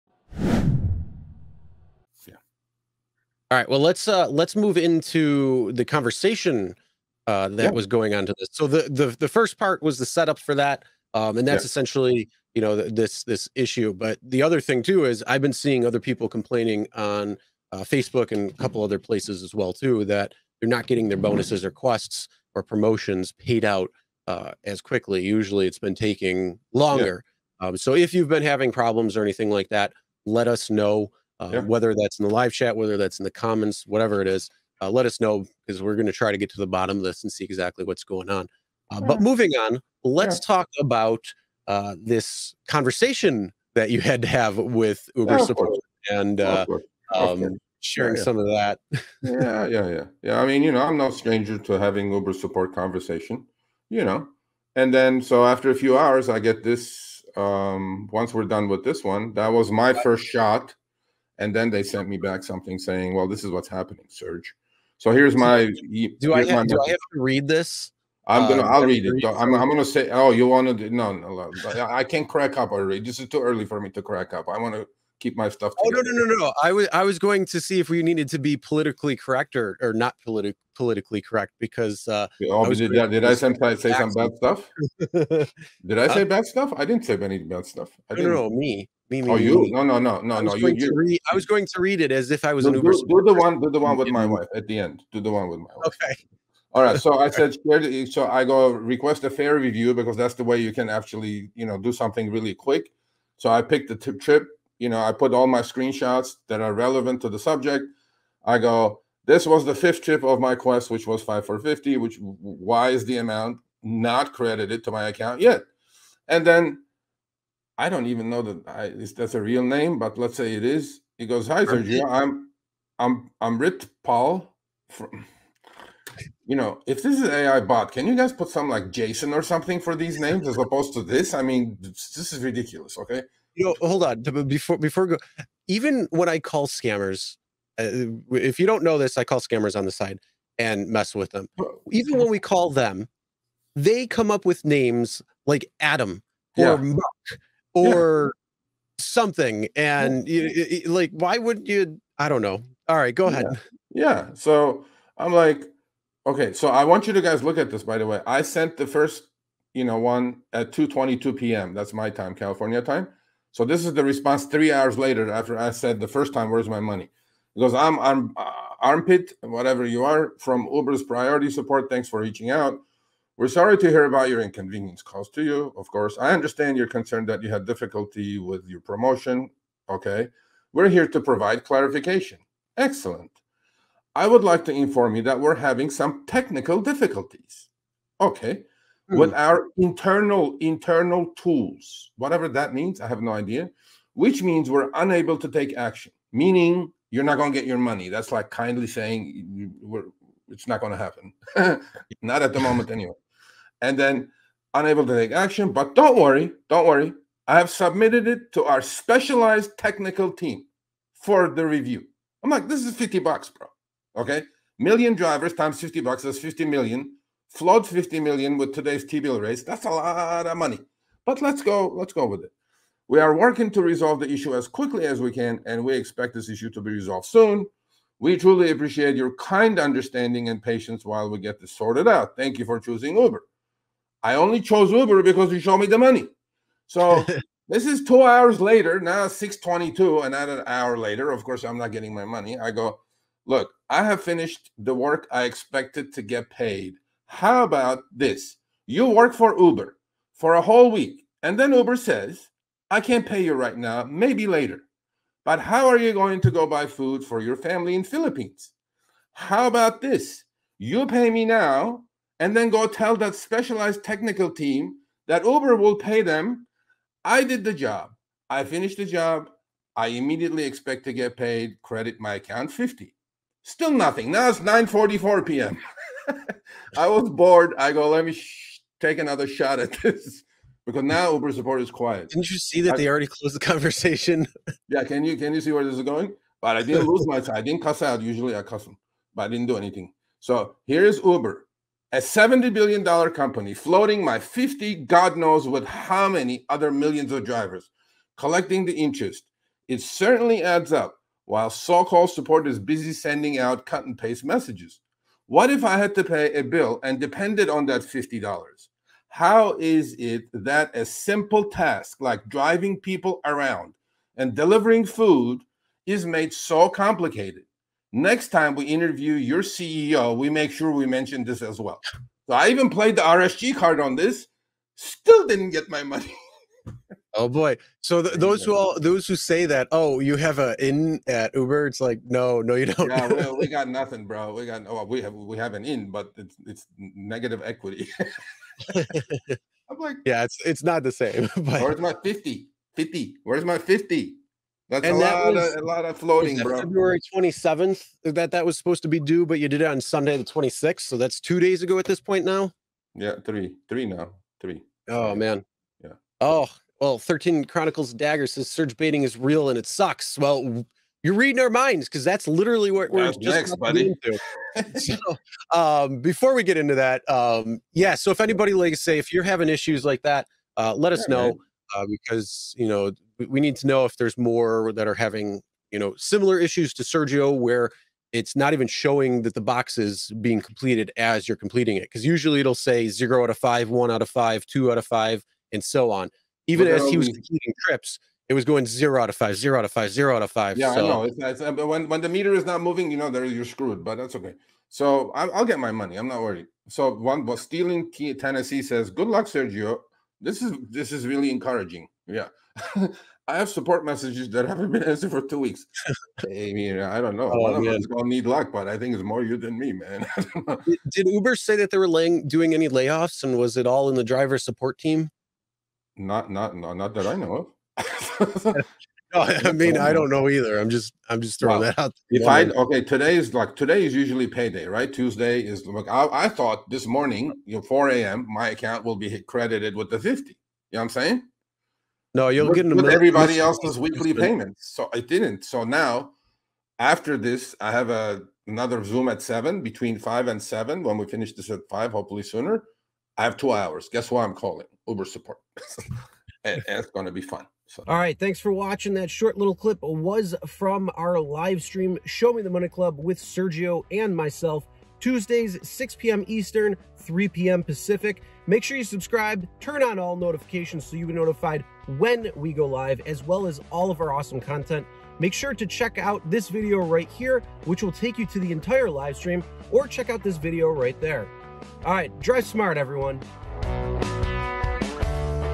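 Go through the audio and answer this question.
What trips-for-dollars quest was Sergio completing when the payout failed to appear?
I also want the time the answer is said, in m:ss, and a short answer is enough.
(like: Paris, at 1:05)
5 for 50, at 1:51.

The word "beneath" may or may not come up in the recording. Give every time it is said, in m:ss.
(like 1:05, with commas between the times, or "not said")
not said.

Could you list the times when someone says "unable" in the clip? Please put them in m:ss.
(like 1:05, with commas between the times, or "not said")
3:14, 3:24.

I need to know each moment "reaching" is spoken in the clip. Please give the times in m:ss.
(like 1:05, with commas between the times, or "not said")
2:52.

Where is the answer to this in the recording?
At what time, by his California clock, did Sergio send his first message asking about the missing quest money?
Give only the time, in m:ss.
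2:40.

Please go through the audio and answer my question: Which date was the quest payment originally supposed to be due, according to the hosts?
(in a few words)
February 27th.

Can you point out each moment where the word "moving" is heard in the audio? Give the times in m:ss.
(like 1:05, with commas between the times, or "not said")
0:39, 6:32.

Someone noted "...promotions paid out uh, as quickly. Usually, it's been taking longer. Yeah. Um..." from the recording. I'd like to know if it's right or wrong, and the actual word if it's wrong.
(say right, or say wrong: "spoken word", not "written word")
right.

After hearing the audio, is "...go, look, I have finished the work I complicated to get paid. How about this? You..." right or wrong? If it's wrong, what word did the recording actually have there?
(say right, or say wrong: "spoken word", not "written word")
wrong: "expected", not "complicated".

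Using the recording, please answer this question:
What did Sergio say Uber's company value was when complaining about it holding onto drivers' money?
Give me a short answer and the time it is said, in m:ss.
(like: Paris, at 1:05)
$70 billion, at 4:52.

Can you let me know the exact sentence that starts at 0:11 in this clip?
essentially you know th- this this issue.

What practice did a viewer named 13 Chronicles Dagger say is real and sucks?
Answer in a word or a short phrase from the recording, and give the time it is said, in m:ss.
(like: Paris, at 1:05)
Surge baiting, at 5:58.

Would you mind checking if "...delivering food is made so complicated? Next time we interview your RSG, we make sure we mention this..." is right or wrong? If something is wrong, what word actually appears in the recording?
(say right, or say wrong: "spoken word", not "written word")
wrong: "CEO", not "RSG".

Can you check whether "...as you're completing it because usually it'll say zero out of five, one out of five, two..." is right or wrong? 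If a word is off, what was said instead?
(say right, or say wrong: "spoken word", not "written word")
right.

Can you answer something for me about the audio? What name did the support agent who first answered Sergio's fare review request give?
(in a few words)
Rit Paul.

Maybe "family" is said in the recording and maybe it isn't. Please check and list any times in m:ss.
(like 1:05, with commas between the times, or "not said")
4:17.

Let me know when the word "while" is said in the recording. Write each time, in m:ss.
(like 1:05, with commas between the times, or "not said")
3:51, 5:01.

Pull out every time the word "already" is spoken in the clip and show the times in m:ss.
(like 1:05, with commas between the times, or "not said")
1:12, 4:43.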